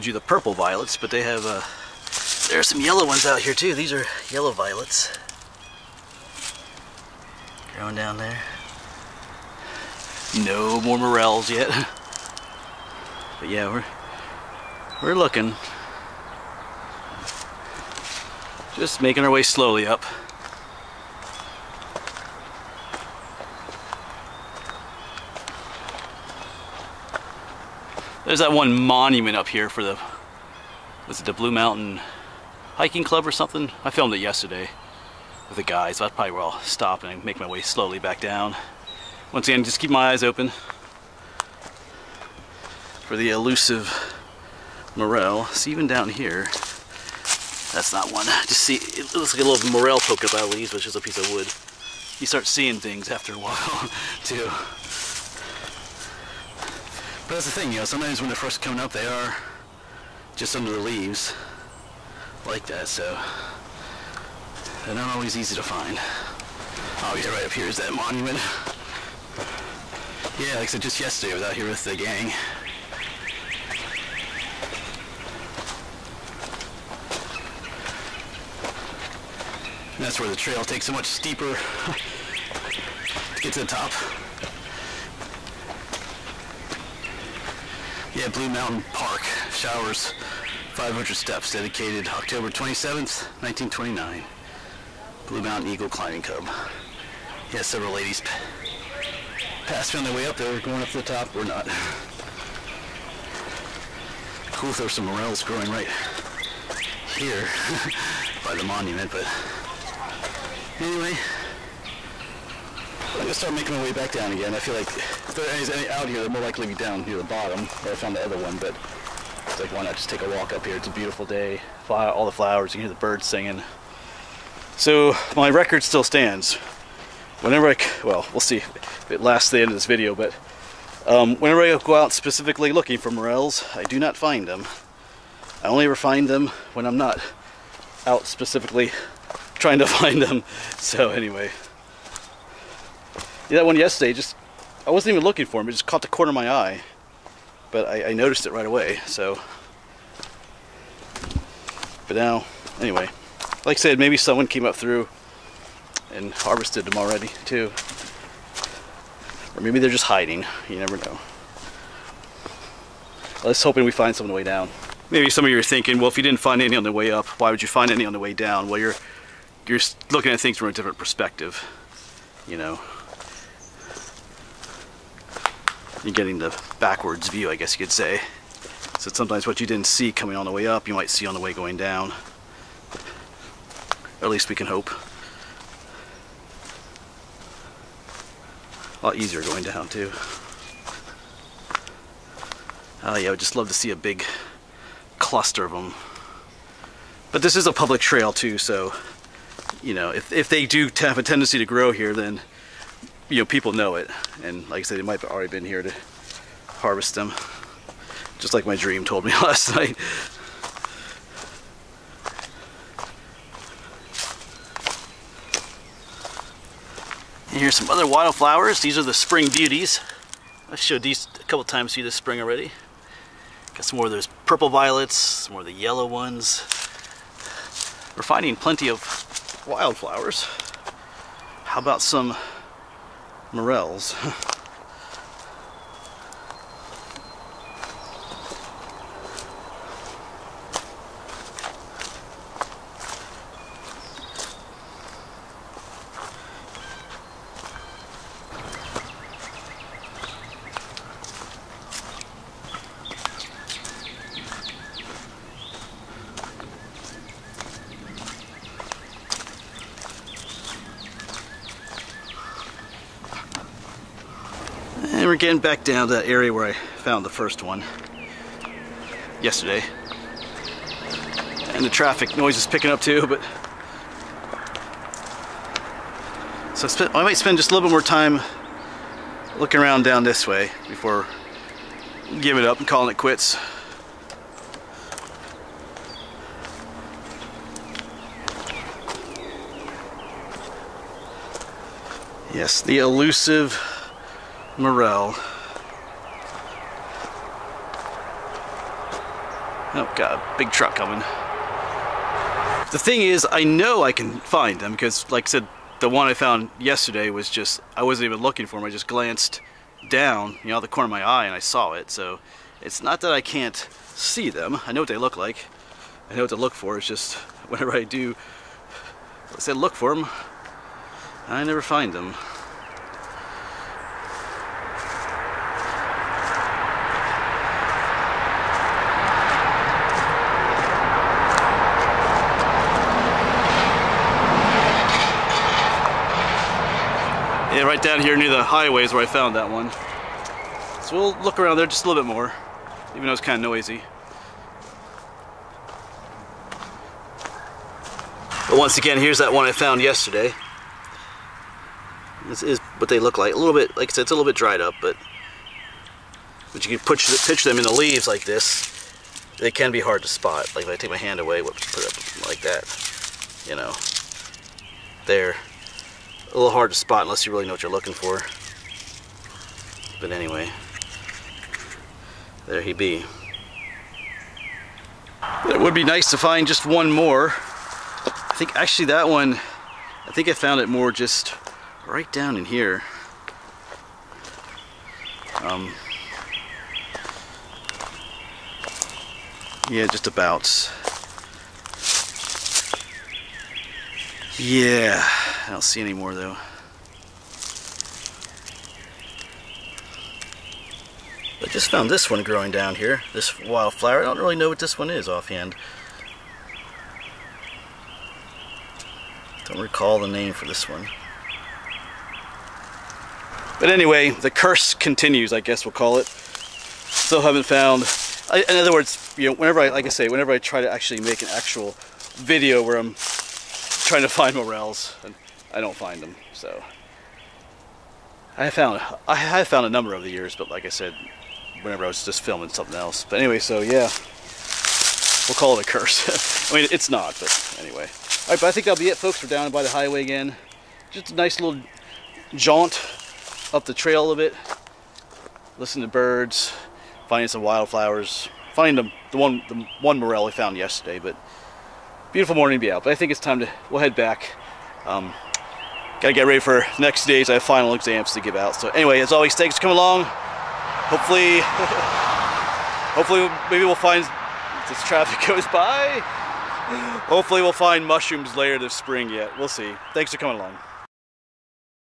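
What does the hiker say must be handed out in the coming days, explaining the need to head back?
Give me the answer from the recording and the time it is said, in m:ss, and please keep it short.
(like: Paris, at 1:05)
Final exams, at 7:37.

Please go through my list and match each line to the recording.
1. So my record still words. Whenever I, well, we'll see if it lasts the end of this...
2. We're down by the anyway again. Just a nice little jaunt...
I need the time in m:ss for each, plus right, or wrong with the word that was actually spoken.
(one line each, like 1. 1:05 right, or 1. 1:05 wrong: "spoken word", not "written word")
1. 2:04 wrong: "stands", not "words"
2. 7:19 wrong: "highway", not "anyway".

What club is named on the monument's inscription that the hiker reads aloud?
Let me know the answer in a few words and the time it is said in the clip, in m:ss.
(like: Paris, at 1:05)
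Blue Mountain Eagle Climbing Club, at 1:35.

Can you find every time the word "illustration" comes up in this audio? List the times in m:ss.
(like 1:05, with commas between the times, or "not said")
not said.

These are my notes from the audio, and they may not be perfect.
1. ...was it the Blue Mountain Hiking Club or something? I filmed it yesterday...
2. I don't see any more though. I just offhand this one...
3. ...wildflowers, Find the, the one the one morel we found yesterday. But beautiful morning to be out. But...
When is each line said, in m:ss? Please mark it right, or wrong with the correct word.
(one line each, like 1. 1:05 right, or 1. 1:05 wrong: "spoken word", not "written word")
1. 0:31 right
2. 6:35 wrong: "found", not "offhand"
3. 7:27 right.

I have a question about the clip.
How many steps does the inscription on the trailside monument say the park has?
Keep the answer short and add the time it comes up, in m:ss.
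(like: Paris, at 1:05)
500, at 1:30.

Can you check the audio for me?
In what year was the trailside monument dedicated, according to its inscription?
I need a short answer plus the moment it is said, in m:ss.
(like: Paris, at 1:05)
1929, at 1:33.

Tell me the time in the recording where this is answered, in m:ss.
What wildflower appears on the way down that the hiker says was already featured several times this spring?
3:39.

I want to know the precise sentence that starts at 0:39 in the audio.
Once again, just keep my eyes open for the elusive morel.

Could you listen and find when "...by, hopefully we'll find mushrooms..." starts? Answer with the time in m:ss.
7:45.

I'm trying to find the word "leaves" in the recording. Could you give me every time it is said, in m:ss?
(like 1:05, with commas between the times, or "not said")
0:50, 1:00, 5:57.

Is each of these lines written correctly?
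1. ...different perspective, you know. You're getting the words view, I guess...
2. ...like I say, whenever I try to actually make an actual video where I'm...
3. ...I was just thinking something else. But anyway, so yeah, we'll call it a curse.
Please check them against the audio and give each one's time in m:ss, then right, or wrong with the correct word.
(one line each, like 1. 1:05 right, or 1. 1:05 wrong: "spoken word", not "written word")
1. 2:50 wrong: "backwards", not "words"
2. 6:59 right
3. 7:12 wrong: "filming", not "thinking".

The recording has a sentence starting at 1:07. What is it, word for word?
Oh yeah, right up here is that monument.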